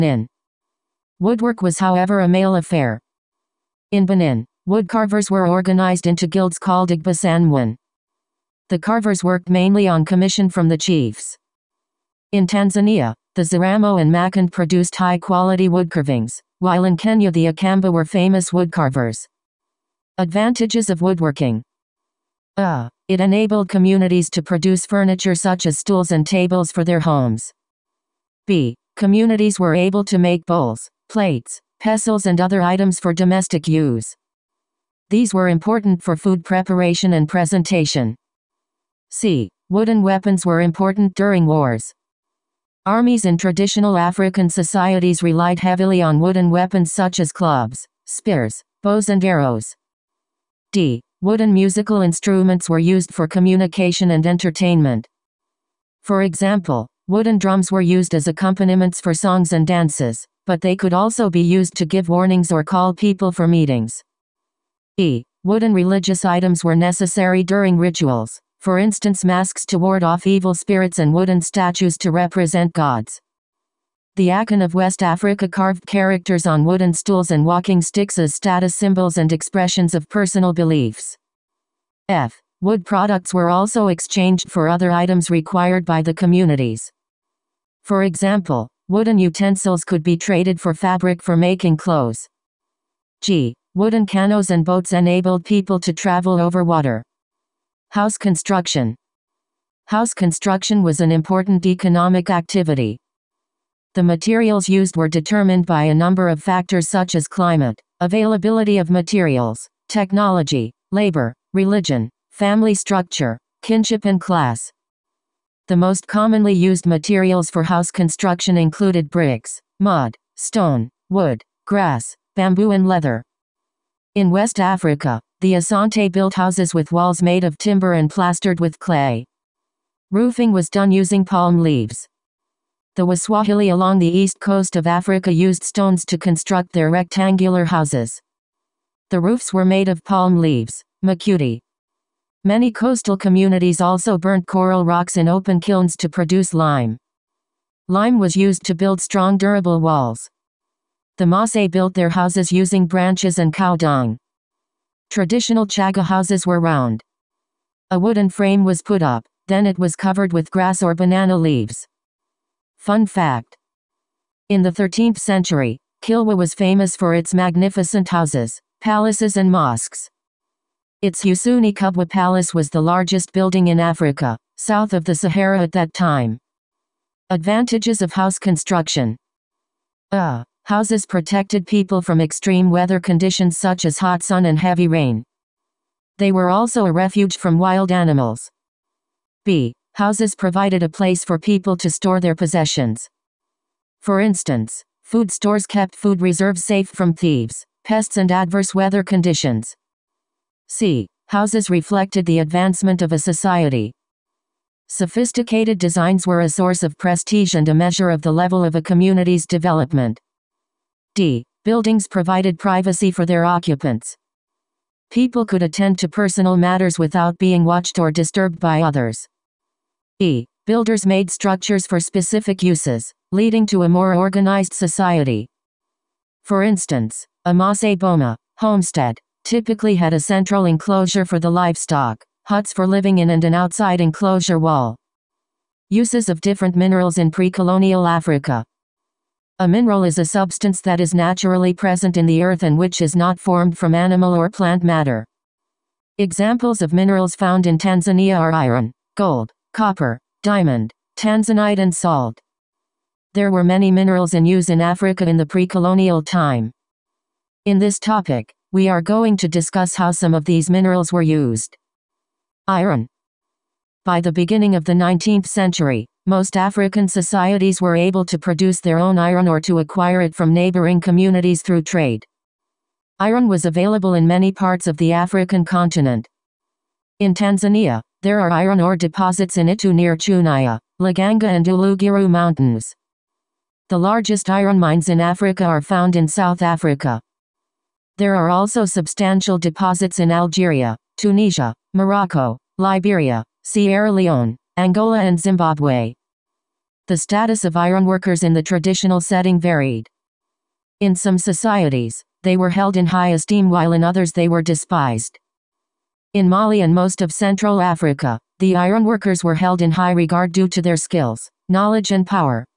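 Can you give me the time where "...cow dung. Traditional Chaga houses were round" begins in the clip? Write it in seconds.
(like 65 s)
153 s.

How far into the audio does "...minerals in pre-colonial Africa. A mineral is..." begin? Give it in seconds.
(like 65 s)
236 s.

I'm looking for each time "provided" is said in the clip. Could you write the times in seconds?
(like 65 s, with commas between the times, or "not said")
190 s, 212 s.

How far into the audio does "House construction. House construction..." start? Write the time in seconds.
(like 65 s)
97 s.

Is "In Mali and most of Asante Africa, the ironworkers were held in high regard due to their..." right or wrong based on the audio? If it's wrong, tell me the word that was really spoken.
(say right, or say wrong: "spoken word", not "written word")
wrong: "Central", not "Asante".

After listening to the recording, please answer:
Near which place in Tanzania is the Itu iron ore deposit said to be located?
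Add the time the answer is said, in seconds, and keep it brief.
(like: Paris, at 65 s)
Chunya, at 280 s.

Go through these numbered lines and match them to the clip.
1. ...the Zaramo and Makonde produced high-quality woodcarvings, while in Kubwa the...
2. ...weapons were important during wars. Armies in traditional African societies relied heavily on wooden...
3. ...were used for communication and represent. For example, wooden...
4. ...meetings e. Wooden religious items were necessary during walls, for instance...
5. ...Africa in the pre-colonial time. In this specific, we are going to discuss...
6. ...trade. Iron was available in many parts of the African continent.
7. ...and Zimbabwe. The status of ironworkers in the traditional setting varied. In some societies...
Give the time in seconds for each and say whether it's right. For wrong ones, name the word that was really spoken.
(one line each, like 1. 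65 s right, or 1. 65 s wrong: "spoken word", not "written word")
1. 13 s wrong: "Kenya", not "Kubwa"
2. 40 s right
3. 52 s wrong: "entertainment", not "represent"
4. 63 s wrong: "rituals", not "walls"
5. 254 s wrong: "topic", not "specific"
6. 271 s right
7. 295 s right.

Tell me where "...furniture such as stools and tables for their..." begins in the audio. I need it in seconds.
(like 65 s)
24 s.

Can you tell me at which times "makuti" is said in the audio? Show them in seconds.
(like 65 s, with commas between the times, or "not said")
141 s.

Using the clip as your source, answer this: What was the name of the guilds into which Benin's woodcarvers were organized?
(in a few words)
Igbasanwin.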